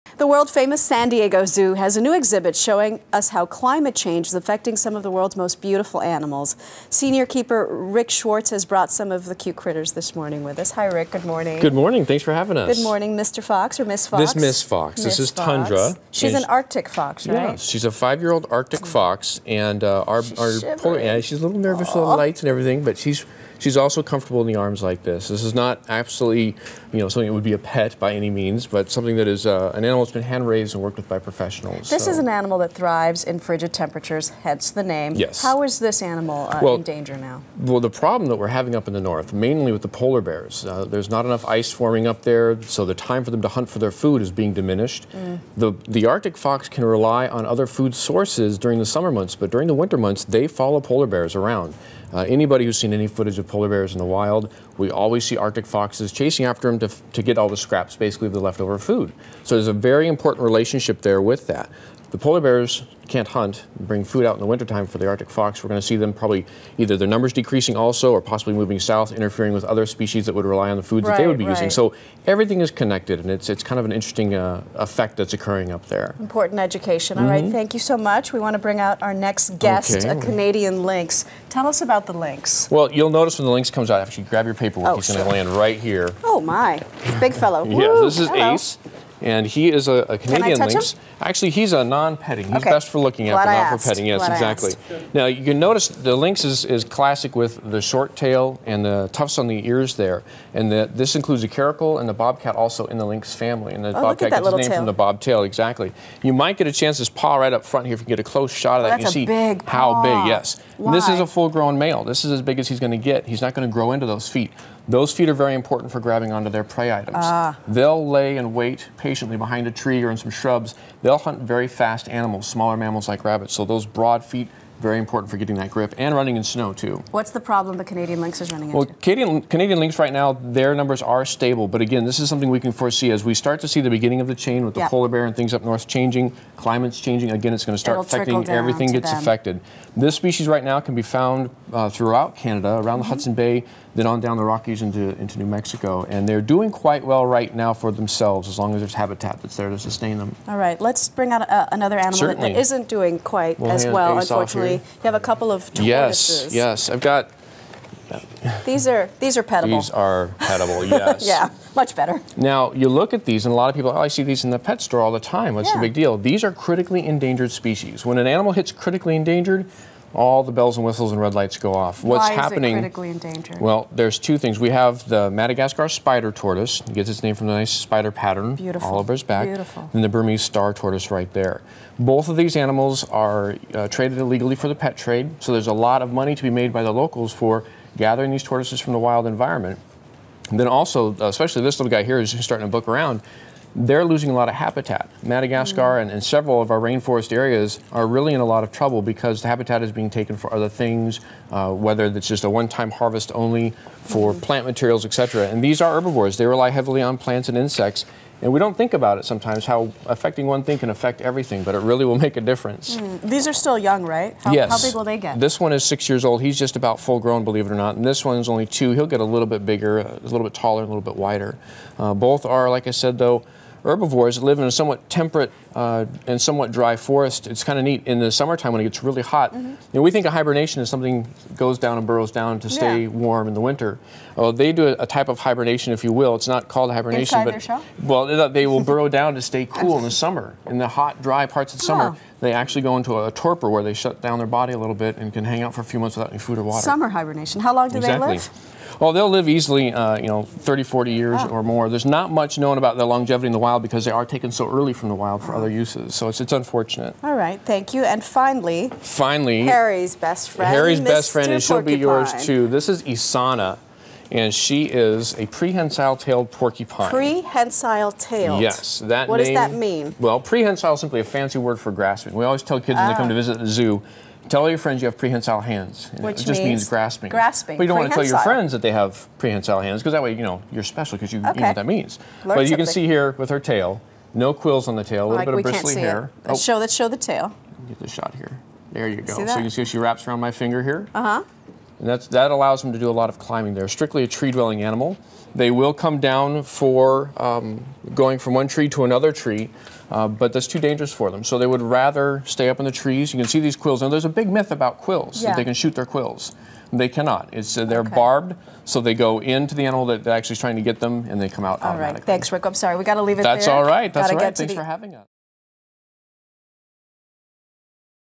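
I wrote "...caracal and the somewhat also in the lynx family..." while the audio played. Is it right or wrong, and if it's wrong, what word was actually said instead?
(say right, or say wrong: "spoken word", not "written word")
wrong: "bobcat", not "somewhat".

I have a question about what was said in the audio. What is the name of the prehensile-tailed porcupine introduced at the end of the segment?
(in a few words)
Isana.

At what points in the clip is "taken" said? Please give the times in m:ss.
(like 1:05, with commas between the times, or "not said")
3:20, 4:14.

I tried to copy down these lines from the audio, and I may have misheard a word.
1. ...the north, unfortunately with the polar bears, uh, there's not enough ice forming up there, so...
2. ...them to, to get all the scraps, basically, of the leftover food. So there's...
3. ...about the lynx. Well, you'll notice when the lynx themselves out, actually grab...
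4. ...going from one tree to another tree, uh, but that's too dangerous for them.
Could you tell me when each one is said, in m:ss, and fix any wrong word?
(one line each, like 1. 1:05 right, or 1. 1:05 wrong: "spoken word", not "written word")
1. 0:38 wrong: "mainly", not "unfortunately"
2. 0:56 right
3. 1:21 wrong: "comes", not "themselves"
4. 4:58 right.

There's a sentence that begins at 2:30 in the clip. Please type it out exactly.
All right, let's bring out a, another animal Certainly.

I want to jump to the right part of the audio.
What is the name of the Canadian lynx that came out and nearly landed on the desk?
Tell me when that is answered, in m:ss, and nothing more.
1:28.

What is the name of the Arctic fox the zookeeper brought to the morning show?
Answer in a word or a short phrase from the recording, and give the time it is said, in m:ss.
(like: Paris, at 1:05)
Tundra, at 0:15.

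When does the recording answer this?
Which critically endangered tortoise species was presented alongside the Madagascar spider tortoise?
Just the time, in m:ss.
3:00.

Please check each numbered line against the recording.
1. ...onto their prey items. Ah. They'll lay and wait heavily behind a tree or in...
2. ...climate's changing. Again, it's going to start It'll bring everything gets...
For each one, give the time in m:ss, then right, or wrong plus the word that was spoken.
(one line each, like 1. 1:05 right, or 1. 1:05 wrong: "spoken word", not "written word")
1. 1:56 wrong: "patiently", not "heavily"
2. 2:16 wrong: "affecting", not "bring".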